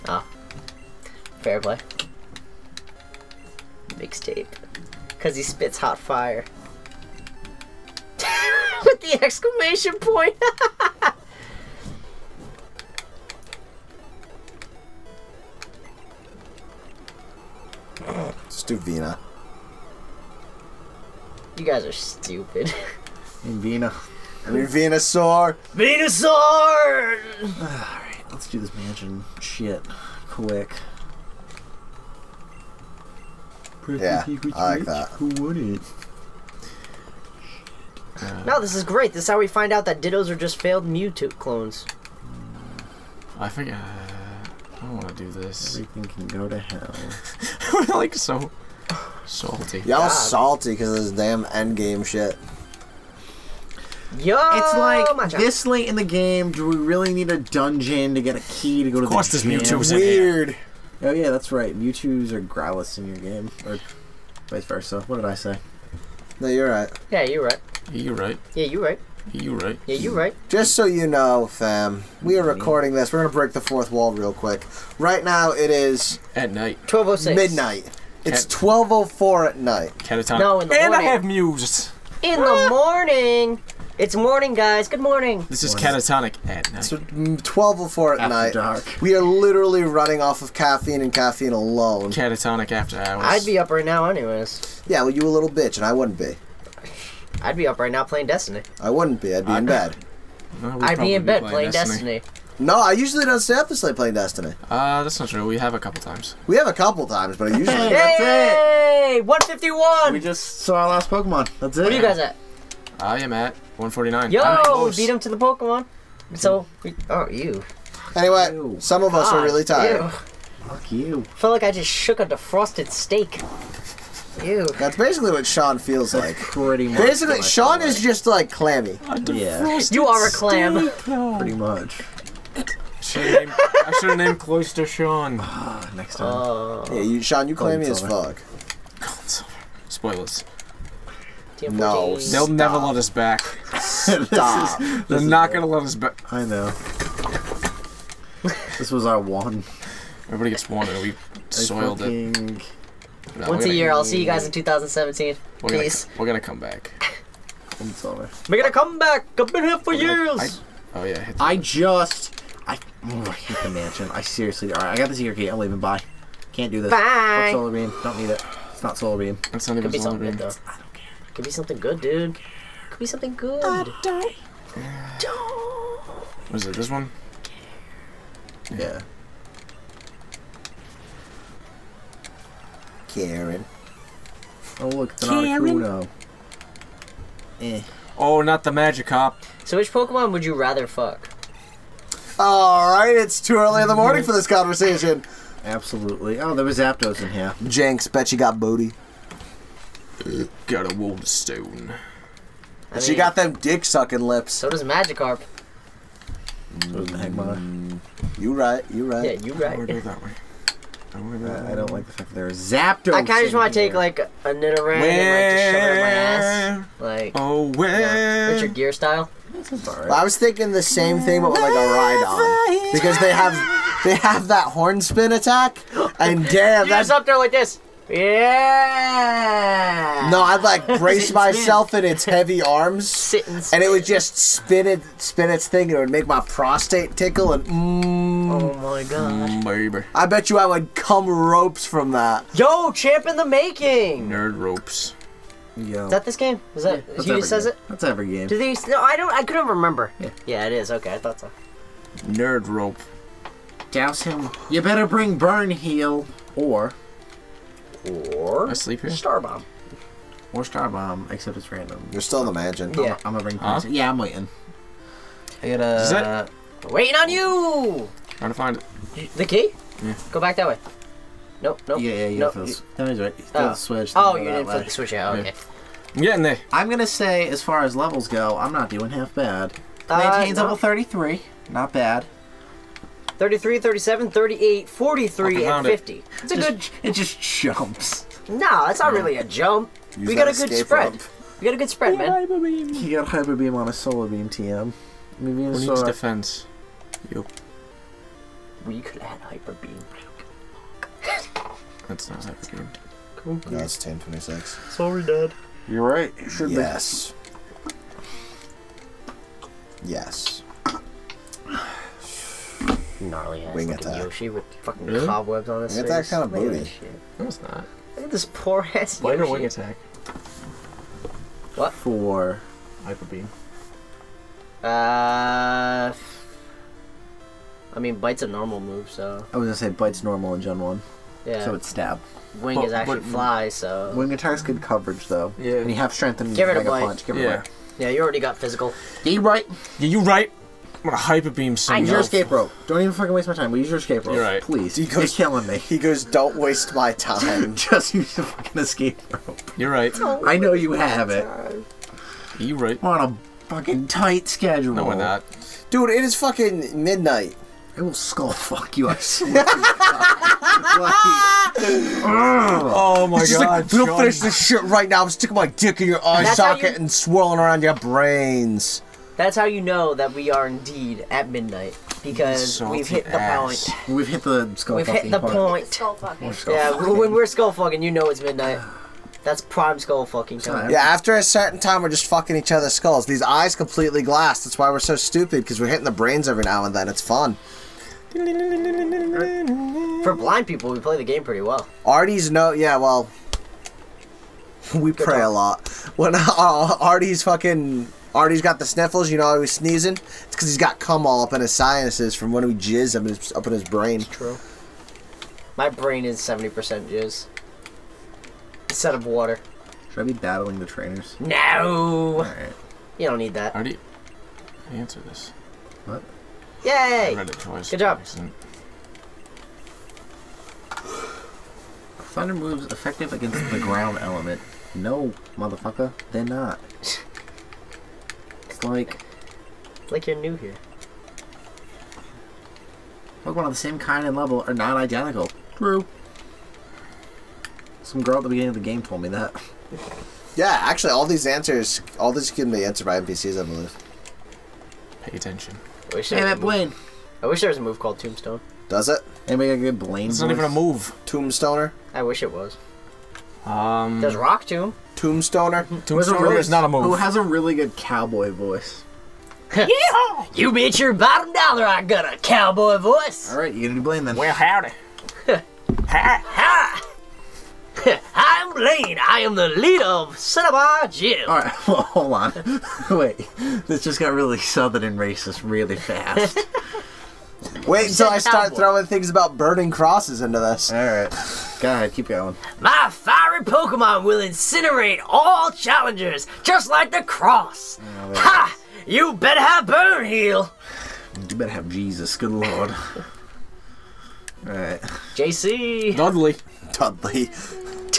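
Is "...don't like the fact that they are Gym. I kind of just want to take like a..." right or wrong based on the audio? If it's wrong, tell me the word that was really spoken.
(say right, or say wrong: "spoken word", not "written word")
wrong: "Zapdos", not "Gym".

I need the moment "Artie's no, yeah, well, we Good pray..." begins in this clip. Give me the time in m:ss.
6:32.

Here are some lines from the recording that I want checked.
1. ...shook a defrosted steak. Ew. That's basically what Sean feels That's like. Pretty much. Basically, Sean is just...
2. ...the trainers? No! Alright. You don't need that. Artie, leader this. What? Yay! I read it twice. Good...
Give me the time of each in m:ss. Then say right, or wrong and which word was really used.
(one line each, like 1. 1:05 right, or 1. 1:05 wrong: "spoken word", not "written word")
1. 2:01 right
2. 6:50 wrong: "answer", not "leader".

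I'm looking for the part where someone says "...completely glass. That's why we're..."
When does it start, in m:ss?
6:23.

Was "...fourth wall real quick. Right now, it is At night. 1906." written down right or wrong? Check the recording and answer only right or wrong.
wrong.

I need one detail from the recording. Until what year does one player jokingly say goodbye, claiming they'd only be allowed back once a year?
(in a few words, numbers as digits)
2017.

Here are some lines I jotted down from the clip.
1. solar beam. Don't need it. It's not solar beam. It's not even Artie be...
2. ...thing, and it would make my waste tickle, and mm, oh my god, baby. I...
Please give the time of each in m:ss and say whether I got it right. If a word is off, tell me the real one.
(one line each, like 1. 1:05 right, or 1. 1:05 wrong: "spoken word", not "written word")
1. 2:47 wrong: "Could", not "Artie"
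2. 3:55 wrong: "prostate", not "waste".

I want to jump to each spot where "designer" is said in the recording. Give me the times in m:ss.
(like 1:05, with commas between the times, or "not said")
not said.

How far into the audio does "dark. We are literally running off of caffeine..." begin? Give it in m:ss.
1:28.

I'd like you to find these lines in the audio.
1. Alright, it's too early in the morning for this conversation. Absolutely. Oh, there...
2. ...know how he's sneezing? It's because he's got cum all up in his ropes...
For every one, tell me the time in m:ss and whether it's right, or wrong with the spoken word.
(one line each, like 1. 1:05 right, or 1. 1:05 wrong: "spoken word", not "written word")
1. 3:12 right
2. 6:39 wrong: "sinuses", not "ropes".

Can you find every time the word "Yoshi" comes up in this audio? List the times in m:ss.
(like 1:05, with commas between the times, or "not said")
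5:14, 5:19.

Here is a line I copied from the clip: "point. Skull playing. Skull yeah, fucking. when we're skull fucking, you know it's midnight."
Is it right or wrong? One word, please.
wrong.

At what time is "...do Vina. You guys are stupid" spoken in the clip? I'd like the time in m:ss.
0:18.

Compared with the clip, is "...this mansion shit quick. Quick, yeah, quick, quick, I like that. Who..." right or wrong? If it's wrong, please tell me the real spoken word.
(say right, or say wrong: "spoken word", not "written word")
right.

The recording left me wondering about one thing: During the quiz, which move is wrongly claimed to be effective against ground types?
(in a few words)
Thunder.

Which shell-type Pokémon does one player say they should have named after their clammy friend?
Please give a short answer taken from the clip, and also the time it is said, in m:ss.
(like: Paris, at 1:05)
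Cloyster, at 2:14.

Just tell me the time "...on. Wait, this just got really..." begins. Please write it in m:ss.
7:52.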